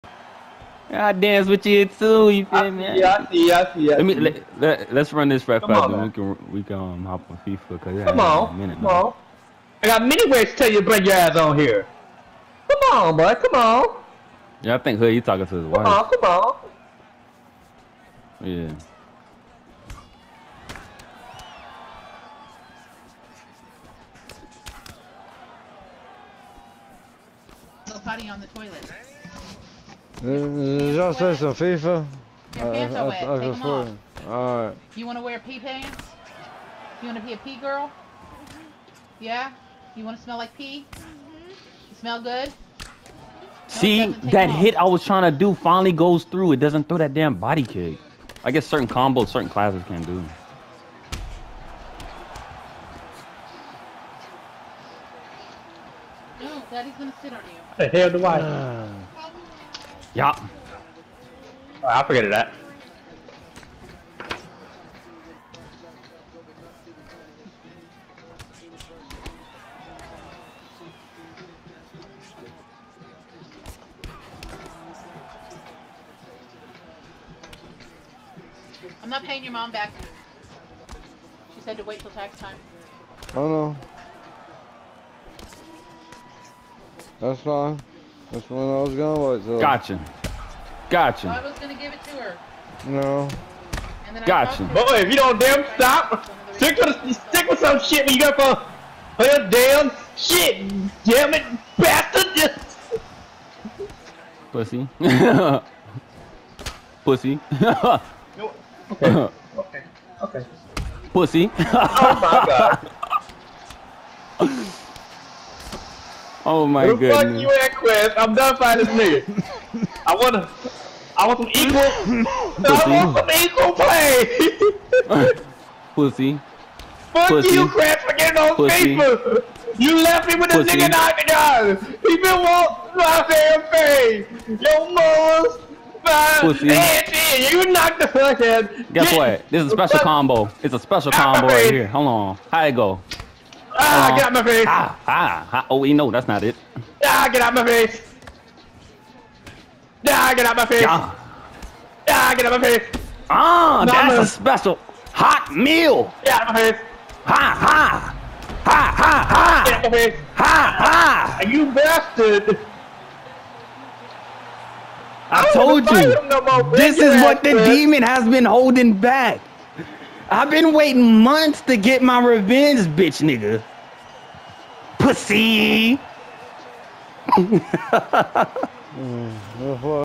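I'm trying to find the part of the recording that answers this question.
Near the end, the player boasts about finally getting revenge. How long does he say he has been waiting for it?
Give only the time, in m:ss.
2:51.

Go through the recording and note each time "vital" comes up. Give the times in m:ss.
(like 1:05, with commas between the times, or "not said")
not said.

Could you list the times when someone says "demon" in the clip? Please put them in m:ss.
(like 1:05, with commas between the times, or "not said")
2:47.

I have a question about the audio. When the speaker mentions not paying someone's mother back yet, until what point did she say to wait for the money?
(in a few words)
tax time.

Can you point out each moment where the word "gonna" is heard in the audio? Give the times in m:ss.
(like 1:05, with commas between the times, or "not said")
0:56.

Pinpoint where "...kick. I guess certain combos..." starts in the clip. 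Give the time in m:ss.
0:47.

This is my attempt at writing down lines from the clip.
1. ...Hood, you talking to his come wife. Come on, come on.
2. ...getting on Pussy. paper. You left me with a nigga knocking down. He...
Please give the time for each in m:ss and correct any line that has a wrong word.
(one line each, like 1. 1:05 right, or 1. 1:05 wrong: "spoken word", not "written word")
1. 0:14 right
2. 2:08 right.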